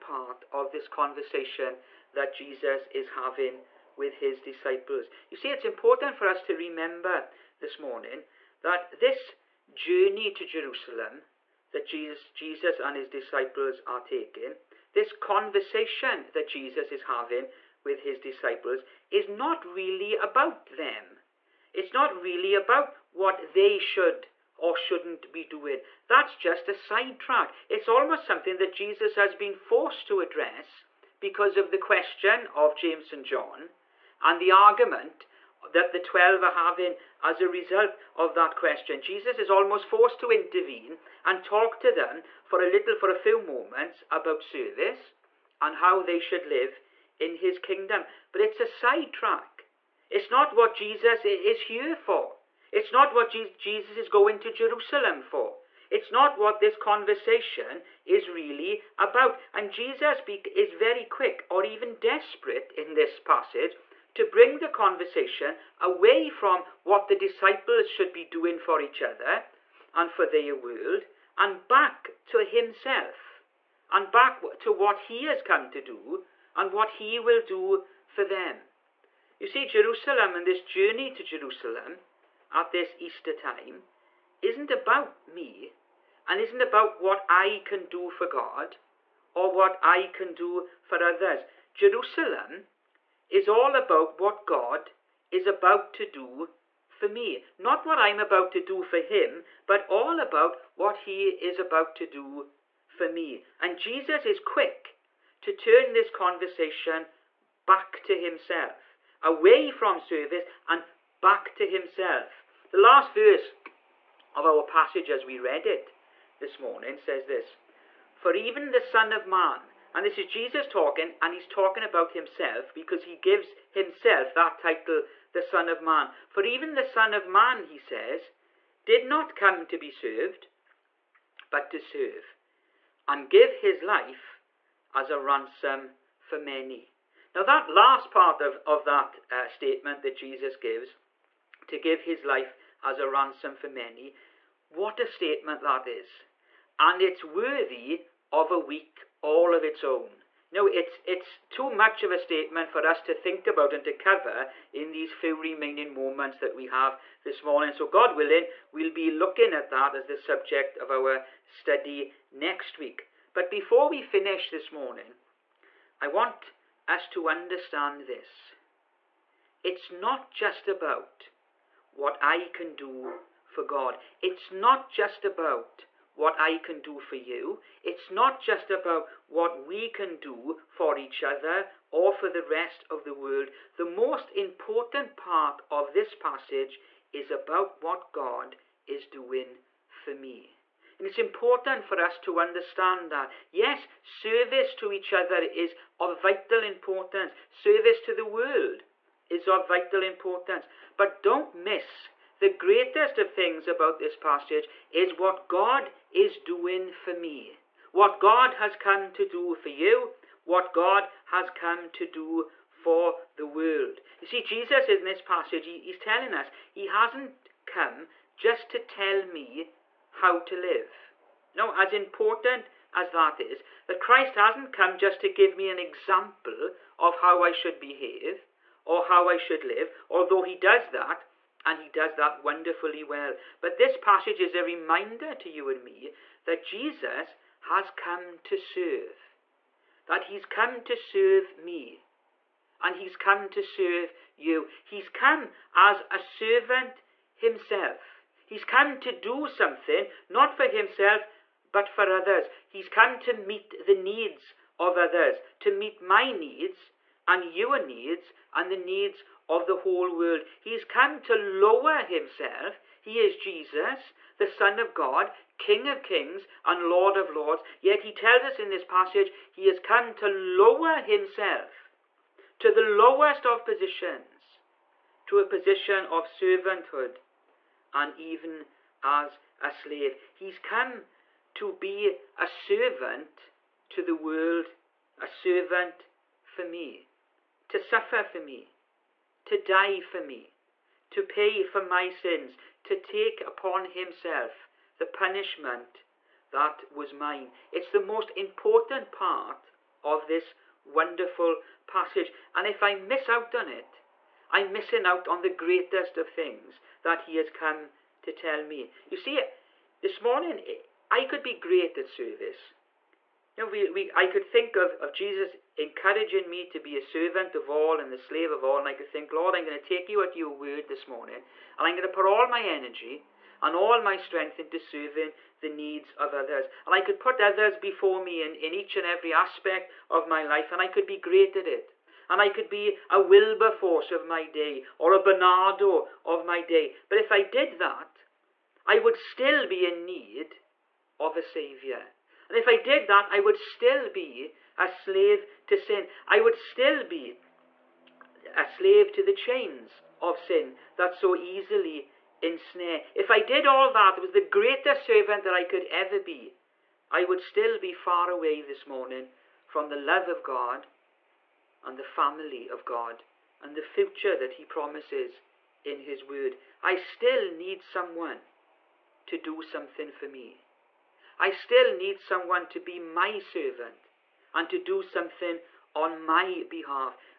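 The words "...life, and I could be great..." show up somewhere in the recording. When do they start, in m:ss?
5:30.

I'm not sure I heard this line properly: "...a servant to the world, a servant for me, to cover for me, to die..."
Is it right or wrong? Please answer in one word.
wrong.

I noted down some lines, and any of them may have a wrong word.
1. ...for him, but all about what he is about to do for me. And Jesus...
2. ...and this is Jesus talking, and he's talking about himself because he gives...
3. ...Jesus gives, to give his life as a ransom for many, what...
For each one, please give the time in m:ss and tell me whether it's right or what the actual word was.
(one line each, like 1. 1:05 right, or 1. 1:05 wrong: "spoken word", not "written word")
1. 1:38 right
2. 1:59 right
3. 2:20 right.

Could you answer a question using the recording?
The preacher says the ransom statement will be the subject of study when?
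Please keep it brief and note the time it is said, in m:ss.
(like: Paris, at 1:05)
next week, at 2:42.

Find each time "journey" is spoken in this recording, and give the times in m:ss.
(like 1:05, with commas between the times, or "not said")
0:09, 1:20.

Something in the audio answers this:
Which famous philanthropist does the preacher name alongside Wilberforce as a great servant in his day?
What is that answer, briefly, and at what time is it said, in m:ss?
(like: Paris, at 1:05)
Barnardo, at 5:35.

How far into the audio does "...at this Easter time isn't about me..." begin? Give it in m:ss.
1:22.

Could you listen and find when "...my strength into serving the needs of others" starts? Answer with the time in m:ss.
5:23.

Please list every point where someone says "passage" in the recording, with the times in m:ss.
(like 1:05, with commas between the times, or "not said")
1:03, 1:54, 3:06, 3:24, 3:35, 3:53, 4:28, 5:01.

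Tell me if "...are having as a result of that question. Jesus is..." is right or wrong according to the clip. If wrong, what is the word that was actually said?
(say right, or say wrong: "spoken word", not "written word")
right.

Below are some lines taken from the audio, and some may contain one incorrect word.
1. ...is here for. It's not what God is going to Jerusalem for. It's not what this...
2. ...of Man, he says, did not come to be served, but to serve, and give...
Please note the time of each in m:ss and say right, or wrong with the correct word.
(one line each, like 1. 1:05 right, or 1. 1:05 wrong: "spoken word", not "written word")
1. 0:51 wrong: "Jesus", not "God"
2. 2:07 right.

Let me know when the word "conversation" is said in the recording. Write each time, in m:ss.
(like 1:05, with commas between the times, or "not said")
0:00, 0:15, 0:56, 1:04, 1:46.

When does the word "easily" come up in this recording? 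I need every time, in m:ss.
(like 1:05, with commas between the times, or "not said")
5:51.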